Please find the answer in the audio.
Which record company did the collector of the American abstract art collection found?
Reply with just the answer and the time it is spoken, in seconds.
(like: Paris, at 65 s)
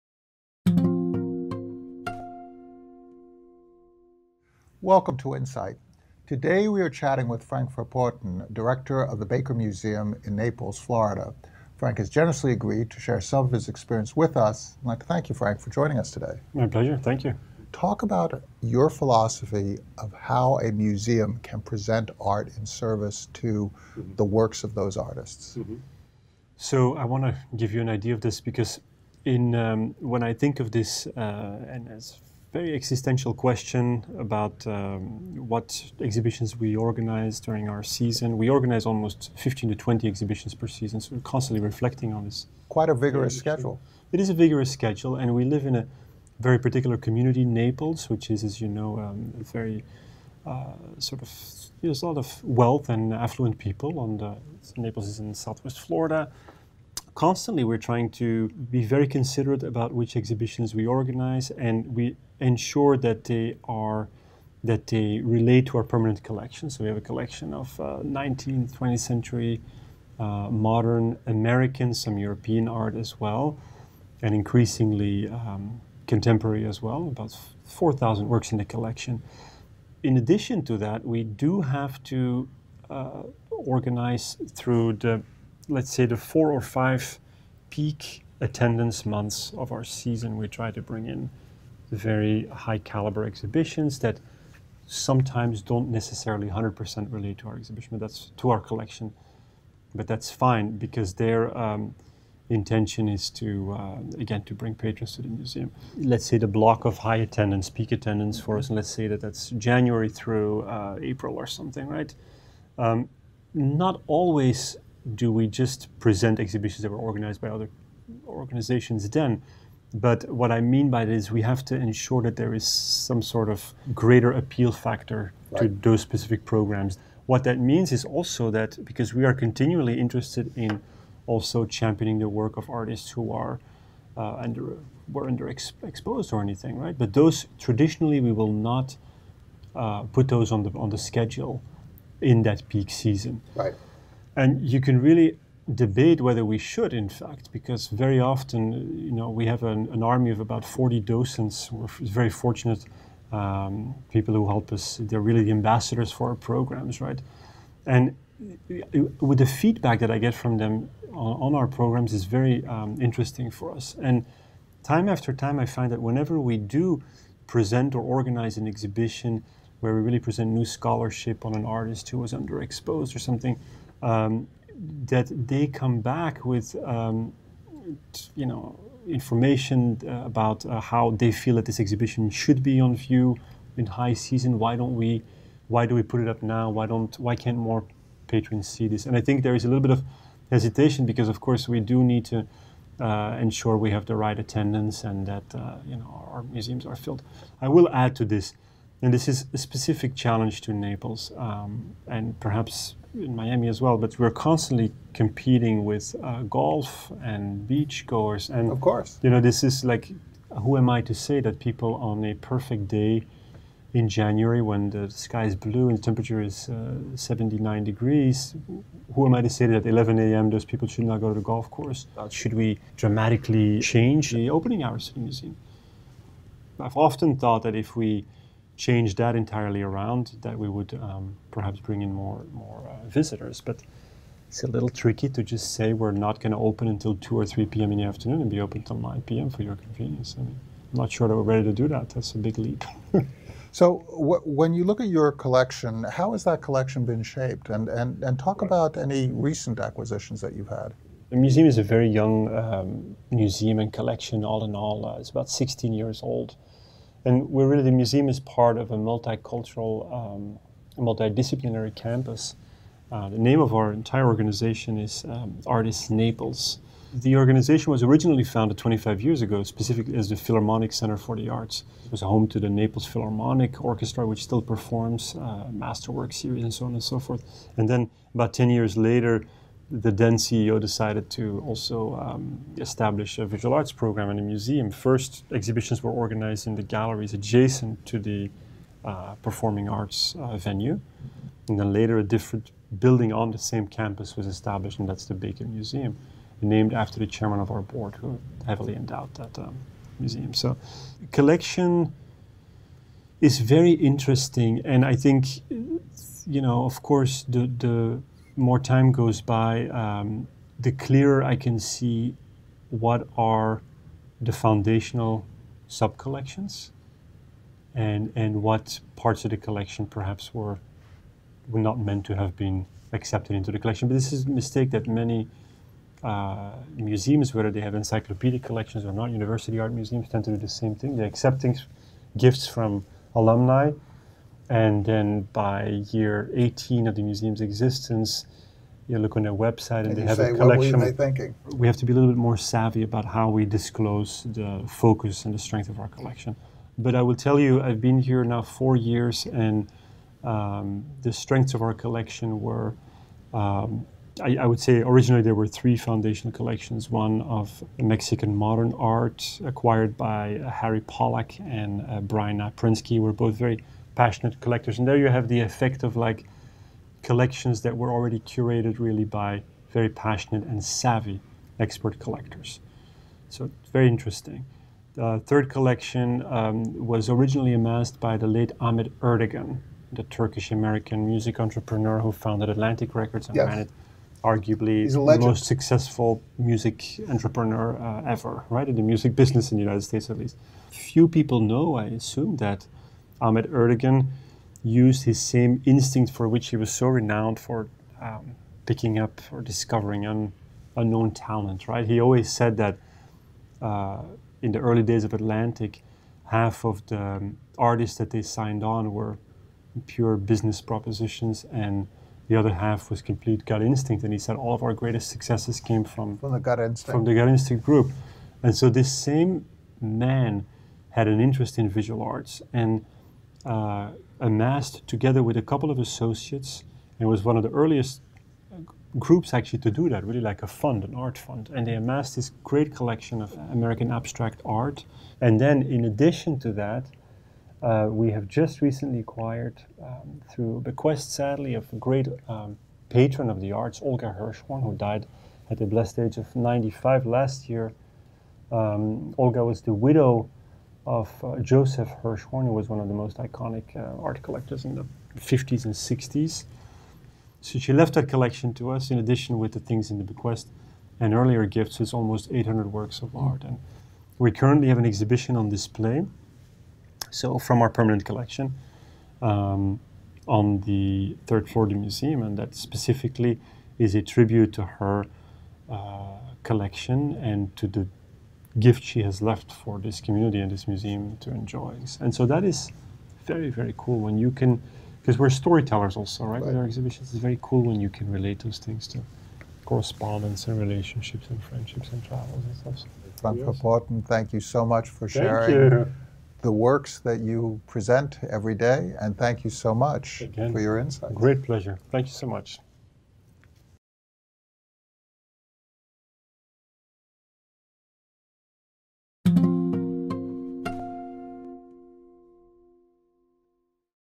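Atlantic Records, at 382 s.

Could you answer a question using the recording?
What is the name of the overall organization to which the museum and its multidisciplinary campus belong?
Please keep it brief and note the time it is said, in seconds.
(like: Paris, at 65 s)
Artis Naples, at 265 s.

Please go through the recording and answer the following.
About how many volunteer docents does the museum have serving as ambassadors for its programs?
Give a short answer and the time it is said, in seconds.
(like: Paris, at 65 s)
40, at 150 s.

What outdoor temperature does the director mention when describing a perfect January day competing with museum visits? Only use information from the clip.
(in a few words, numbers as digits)
79 degrees.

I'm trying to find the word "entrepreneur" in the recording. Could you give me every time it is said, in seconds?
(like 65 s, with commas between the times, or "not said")
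381 s, 387 s.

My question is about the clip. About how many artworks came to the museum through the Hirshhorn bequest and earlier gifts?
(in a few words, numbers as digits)
800.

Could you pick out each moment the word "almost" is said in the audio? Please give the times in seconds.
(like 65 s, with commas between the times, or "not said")
38 s, 462 s.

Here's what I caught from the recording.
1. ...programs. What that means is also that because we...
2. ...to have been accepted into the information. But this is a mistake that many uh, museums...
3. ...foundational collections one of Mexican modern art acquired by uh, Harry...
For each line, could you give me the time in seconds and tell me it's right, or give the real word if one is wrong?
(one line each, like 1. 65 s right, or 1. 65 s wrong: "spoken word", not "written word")
1. 126 s right
2. 322 s wrong: "collection", not "information"
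3. 355 s right.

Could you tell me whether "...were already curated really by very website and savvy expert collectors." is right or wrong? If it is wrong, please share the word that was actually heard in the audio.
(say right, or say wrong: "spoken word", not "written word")
wrong: "passionate", not "website".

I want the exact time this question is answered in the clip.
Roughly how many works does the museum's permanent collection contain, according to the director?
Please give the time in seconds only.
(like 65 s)
77 s.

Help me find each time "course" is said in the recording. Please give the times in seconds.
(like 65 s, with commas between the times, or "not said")
191 s, 208 s, 221 s, 307 s.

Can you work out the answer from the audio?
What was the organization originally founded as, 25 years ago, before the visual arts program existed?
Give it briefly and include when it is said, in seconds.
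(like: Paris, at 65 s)
Philharmonic Center for the Arts, at 270 s.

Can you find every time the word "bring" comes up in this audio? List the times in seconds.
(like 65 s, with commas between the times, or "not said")
90 s, 104 s, 231 s.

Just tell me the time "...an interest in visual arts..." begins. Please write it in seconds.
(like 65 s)
421 s.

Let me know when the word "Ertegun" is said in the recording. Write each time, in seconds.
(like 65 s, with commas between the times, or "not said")
379 s, 393 s.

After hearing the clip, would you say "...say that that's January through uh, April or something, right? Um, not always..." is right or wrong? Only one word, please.
right.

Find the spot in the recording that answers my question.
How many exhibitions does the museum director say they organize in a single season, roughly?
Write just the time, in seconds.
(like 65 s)
39 s.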